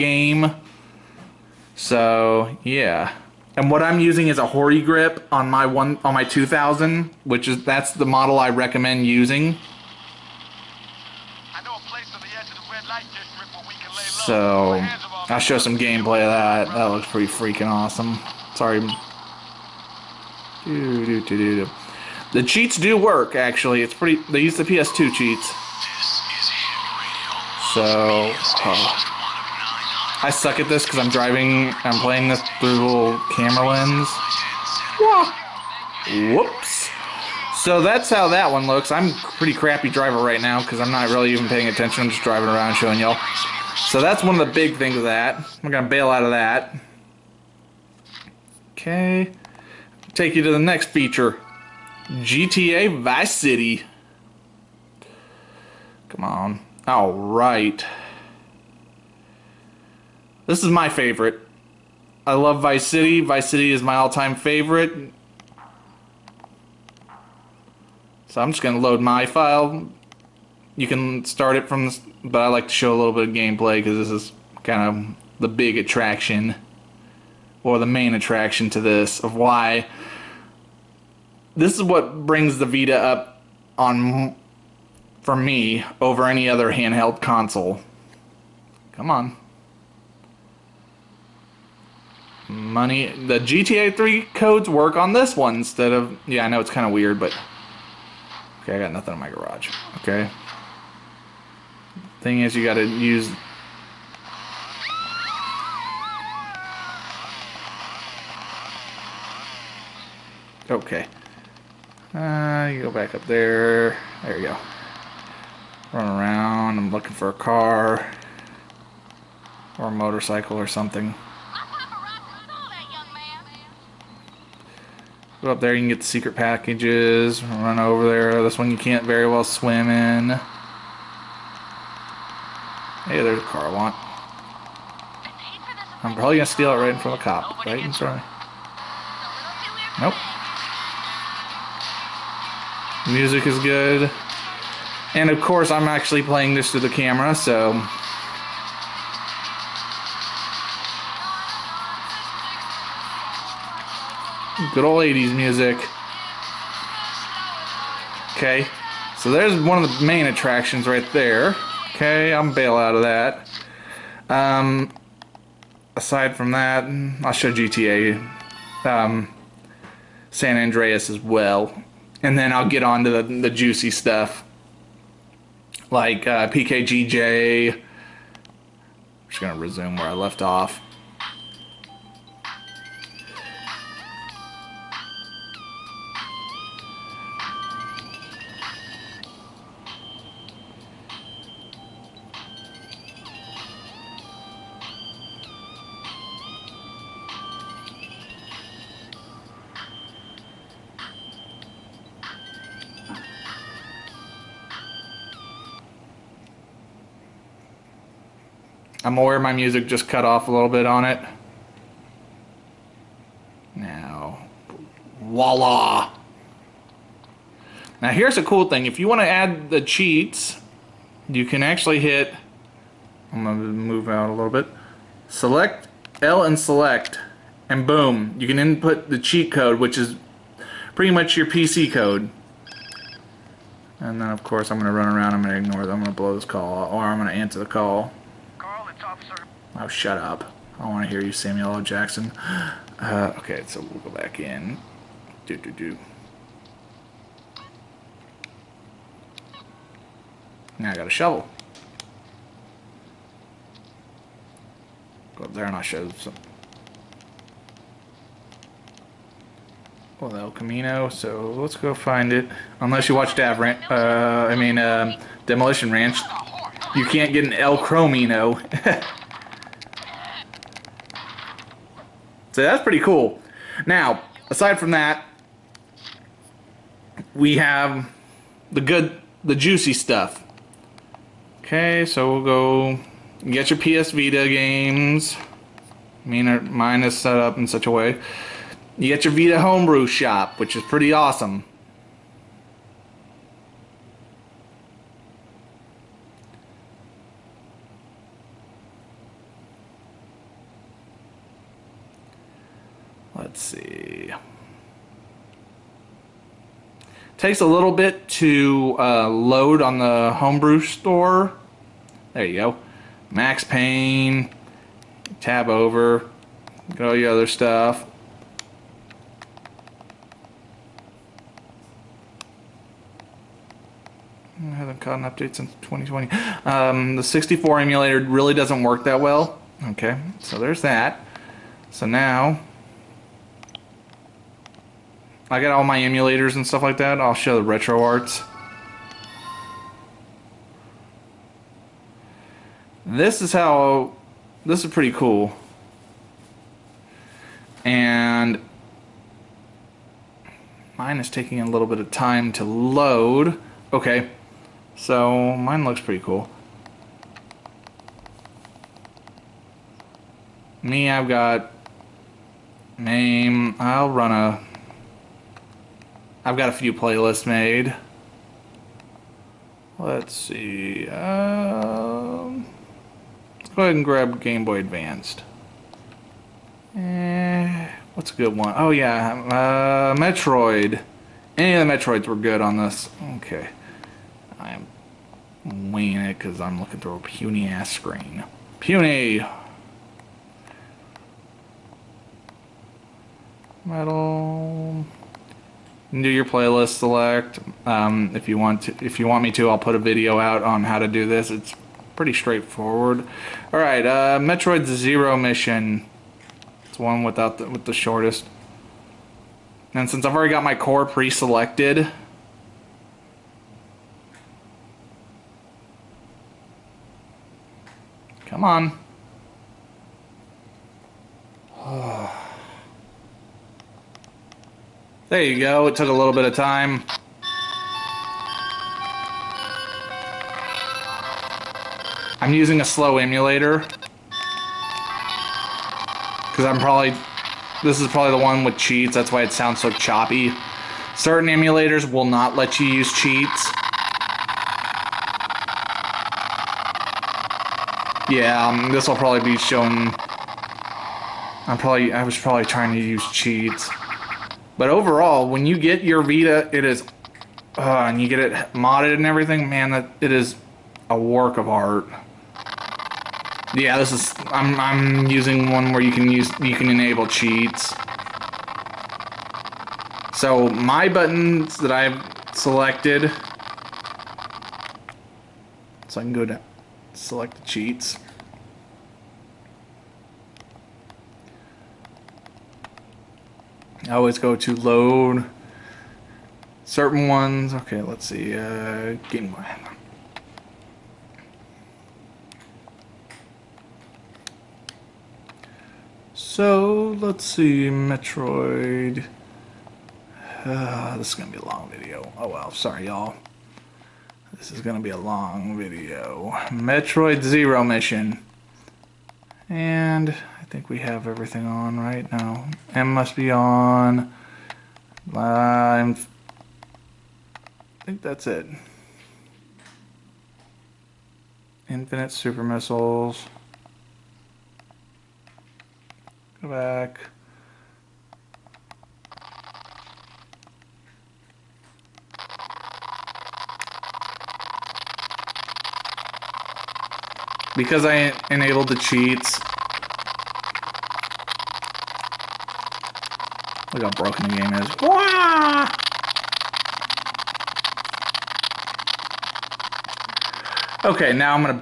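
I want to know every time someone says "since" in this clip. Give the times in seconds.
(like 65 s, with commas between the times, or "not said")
325 s, 410 s.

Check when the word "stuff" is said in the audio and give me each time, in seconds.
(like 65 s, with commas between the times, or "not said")
173 s, 279 s, 317 s, 336 s.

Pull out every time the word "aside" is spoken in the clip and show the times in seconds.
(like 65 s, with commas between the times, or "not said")
165 s, 274 s.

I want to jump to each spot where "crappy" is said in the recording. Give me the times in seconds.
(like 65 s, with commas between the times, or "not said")
39 s.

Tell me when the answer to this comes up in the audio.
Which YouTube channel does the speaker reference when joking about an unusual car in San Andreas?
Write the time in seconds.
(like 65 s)
265 s.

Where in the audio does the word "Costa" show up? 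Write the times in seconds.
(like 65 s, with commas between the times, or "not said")
not said.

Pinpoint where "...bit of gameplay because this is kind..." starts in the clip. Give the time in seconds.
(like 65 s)
73 s.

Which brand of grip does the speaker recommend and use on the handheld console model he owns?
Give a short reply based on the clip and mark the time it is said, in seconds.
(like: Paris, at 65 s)
Hori, at 4 s.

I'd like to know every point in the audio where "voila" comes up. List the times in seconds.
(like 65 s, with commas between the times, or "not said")
215 s.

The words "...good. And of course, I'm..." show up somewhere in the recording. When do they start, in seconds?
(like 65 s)
143 s.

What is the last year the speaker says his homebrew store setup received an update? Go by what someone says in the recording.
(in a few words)
2020.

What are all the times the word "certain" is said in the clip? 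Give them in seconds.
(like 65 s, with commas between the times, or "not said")
441 s, 486 s.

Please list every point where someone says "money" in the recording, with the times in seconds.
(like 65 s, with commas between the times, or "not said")
92 s.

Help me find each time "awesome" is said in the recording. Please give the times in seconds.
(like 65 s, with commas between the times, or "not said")
17 s, 291 s.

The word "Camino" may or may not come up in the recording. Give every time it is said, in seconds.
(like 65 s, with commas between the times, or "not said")
260 s.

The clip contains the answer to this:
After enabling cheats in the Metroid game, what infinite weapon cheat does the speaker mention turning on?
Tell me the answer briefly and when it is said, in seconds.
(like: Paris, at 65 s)
Infinite super missiles, at 521 s.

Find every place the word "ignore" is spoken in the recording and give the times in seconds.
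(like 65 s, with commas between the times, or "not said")
235 s.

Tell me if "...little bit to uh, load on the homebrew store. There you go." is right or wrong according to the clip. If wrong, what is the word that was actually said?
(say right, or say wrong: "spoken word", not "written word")
right.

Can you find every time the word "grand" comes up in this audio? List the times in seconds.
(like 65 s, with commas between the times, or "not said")
not said.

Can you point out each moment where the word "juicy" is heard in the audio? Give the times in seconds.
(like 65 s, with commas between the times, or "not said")
173 s, 279 s.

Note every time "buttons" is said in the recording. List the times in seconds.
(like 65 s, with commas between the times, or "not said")
471 s.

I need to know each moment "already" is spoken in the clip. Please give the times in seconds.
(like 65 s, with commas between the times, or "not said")
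410 s.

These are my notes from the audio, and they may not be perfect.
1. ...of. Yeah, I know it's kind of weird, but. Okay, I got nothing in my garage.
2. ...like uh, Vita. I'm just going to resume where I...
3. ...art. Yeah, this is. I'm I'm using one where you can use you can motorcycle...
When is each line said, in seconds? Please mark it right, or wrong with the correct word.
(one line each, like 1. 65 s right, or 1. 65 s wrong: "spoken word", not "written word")
1. 95 s right
2. 175 s wrong: "PKGJ", not "Vita"
3. 461 s wrong: "enable", not "motorcycle".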